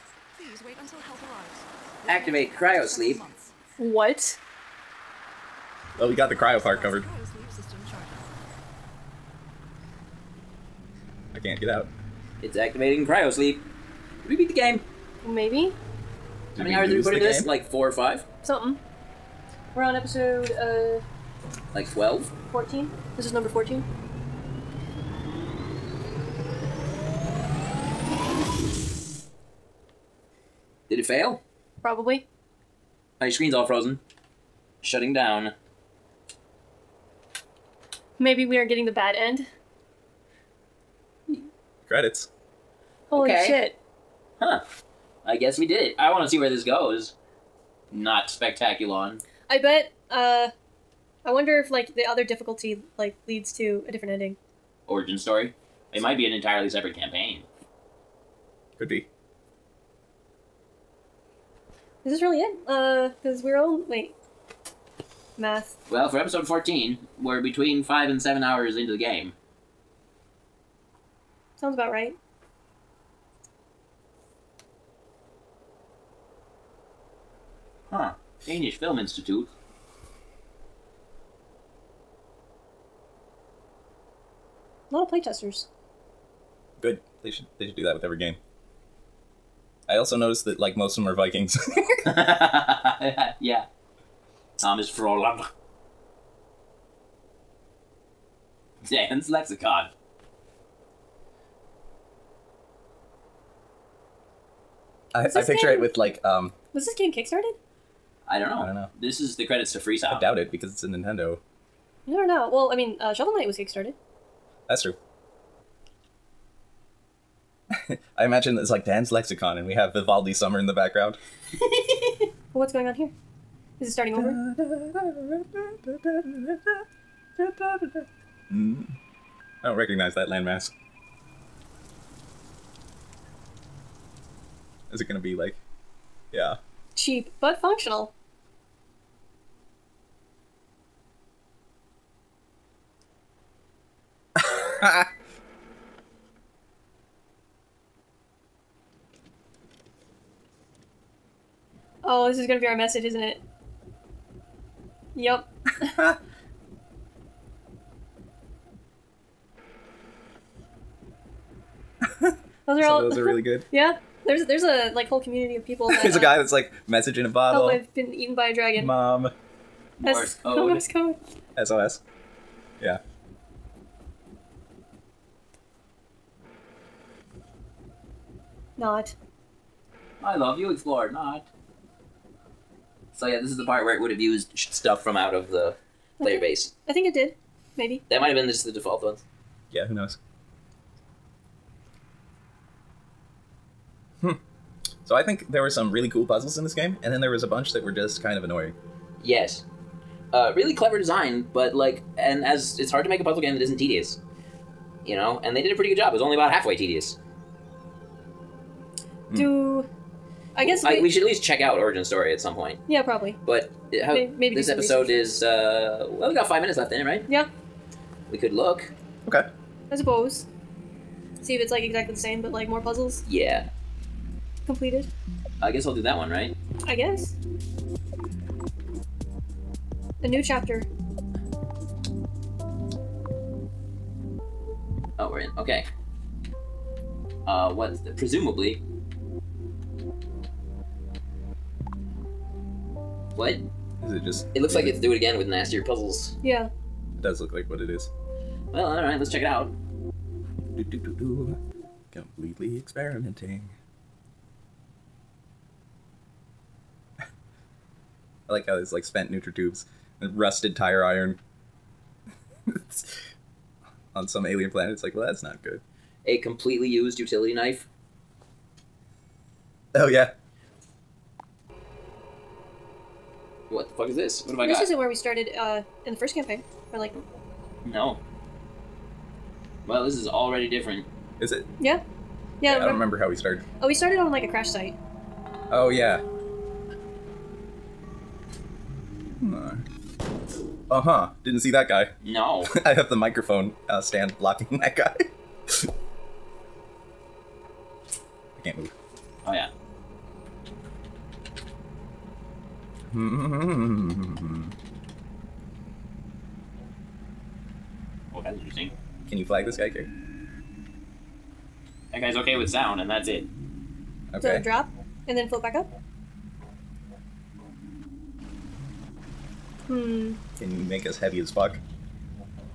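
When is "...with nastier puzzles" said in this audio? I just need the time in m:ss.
4:05.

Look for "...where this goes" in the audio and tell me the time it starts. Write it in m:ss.
0:46.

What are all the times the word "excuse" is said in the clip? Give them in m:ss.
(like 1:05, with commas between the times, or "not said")
not said.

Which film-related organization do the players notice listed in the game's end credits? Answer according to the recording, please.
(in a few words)
Danish Film Institute.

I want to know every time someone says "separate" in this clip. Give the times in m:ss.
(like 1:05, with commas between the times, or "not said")
0:56.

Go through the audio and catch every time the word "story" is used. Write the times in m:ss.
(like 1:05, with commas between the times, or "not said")
0:55, 3:32.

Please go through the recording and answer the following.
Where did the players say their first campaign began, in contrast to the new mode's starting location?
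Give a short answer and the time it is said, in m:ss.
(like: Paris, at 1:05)
a crash site, at 4:44.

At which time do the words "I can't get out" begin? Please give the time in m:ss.
0:11.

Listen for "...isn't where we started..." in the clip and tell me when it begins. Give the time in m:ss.
4:34.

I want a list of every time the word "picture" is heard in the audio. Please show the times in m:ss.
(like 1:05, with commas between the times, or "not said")
1:45.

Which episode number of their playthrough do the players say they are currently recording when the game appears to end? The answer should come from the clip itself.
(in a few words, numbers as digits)
14.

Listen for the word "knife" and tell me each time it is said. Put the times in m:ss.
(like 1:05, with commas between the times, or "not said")
4:27.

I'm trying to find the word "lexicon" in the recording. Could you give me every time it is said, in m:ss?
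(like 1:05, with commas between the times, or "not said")
1:39, 1:59.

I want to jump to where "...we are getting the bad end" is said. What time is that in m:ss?
0:38.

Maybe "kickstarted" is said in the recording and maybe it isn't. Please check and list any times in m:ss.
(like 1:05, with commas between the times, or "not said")
1:47, 1:53.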